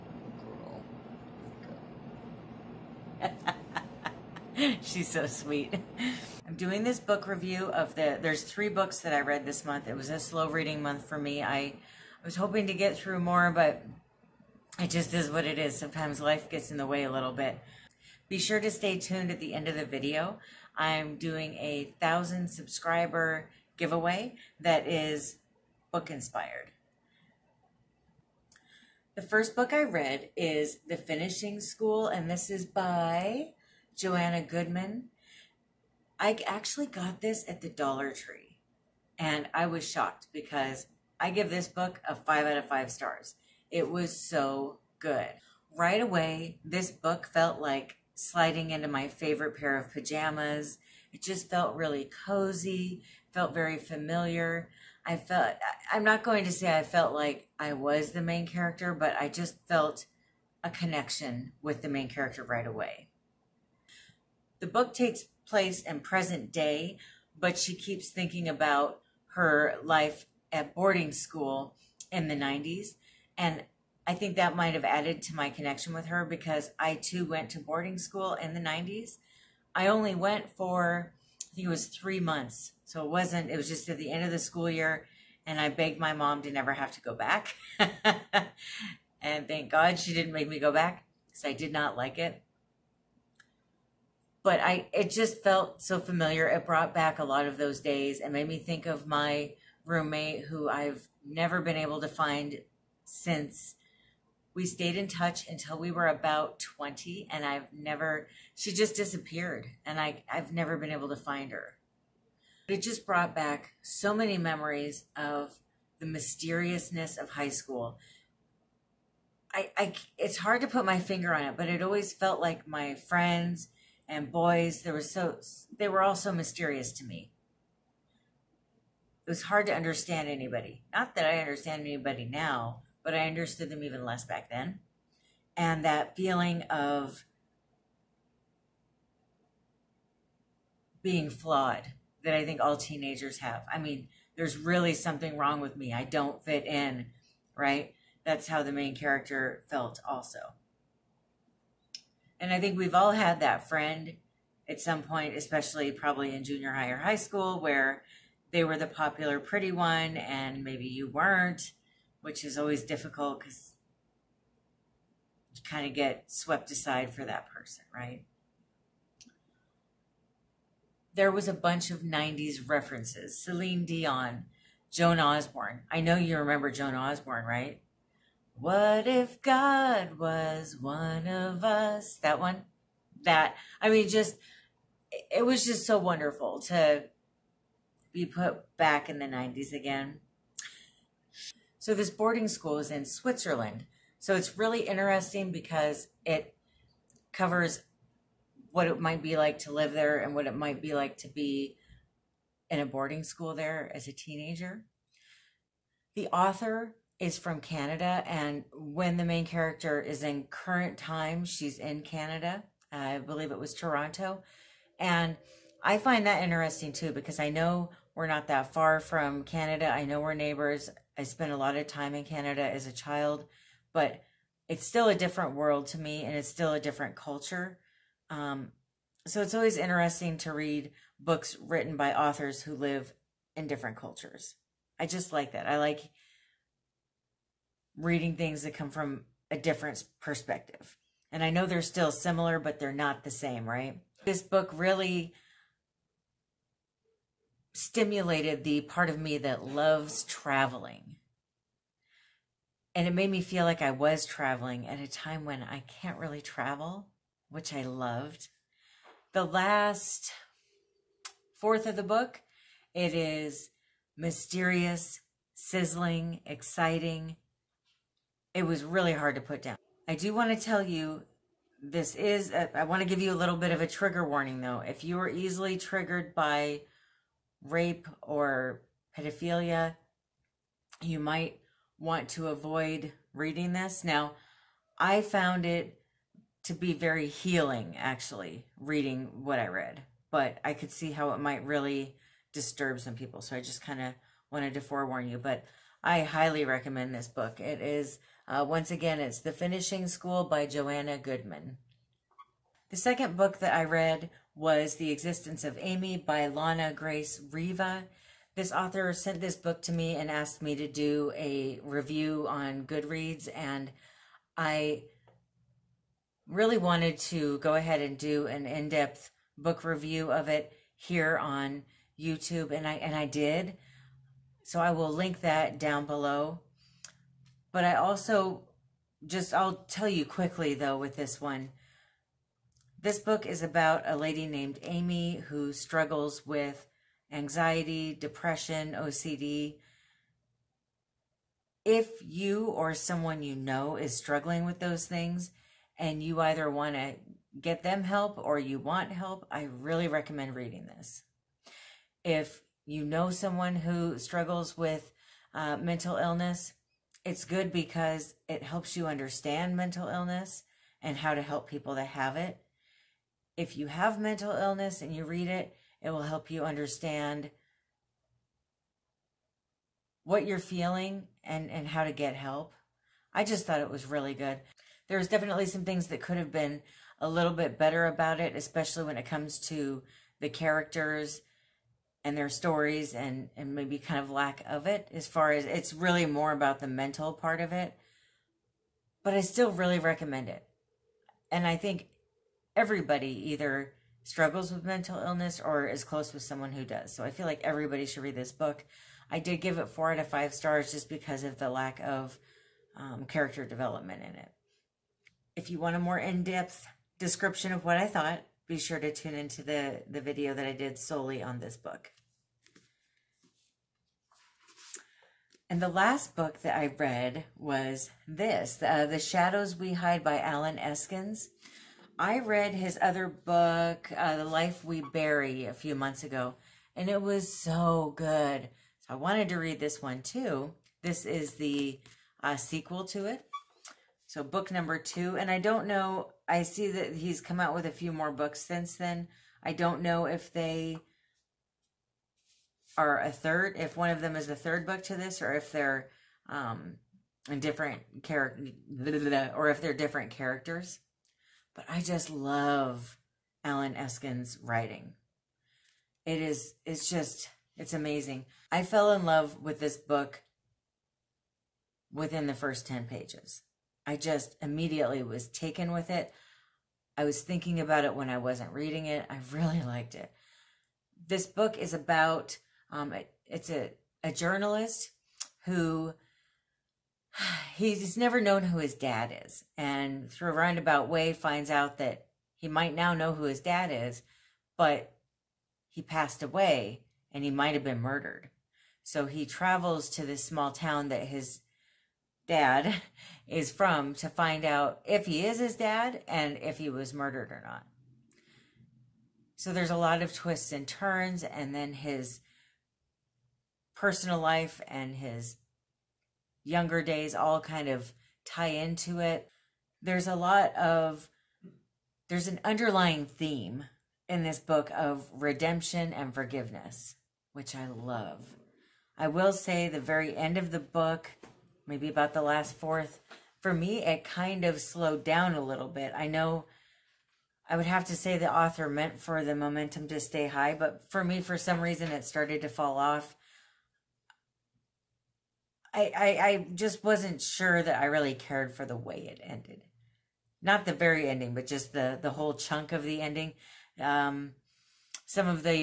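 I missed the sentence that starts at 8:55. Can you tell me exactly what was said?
I, I, I just wasn't sure that I really cared for the way it ended.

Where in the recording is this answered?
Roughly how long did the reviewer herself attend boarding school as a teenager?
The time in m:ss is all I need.
1:21.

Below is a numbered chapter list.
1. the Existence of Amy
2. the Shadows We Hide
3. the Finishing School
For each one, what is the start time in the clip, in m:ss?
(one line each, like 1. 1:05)
1. 5:02
2. 6:55
3. 0:28.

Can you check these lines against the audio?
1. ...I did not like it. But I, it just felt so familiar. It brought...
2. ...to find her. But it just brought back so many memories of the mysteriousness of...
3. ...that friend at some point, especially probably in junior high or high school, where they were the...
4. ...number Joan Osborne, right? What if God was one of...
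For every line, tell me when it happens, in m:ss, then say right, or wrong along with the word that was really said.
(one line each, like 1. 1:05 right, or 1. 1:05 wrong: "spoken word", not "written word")
1. 1:31 right
2. 1:51 right
3. 2:33 right
4. 2:56 wrong: "remember", not "number".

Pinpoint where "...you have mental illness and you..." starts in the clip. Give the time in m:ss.
6:03.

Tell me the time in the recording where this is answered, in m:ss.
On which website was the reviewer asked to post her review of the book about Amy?
5:12.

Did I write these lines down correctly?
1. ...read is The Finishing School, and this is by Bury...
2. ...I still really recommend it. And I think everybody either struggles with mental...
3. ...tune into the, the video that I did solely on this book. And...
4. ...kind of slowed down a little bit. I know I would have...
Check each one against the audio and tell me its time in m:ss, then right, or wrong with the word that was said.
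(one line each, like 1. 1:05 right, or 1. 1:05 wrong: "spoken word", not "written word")
1. 0:29 wrong: "Joanna", not "Bury"
2. 6:29 right
3. 6:49 right
4. 8:44 right.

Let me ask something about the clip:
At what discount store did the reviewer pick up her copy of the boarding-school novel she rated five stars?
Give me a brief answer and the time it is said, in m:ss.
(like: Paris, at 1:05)
Dollar Tree, at 0:37.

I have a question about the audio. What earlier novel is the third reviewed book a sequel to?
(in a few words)
The Life We Bury.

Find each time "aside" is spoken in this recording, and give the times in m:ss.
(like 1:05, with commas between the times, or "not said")
2:46.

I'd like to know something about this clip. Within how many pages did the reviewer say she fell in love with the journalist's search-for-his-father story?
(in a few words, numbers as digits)
10.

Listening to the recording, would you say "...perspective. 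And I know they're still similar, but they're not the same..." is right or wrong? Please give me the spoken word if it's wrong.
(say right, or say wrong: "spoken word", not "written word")
right.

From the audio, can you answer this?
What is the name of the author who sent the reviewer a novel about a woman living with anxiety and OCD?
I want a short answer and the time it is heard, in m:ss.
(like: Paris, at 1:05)
Lana Grace Riva, at 5:06.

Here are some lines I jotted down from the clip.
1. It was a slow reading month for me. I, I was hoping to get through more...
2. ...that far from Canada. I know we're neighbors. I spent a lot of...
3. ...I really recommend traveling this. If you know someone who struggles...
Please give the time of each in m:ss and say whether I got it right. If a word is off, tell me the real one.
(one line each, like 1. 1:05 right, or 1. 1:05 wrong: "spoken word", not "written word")
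1. 0:09 right
2. 3:38 right
3. 5:49 wrong: "reading", not "traveling".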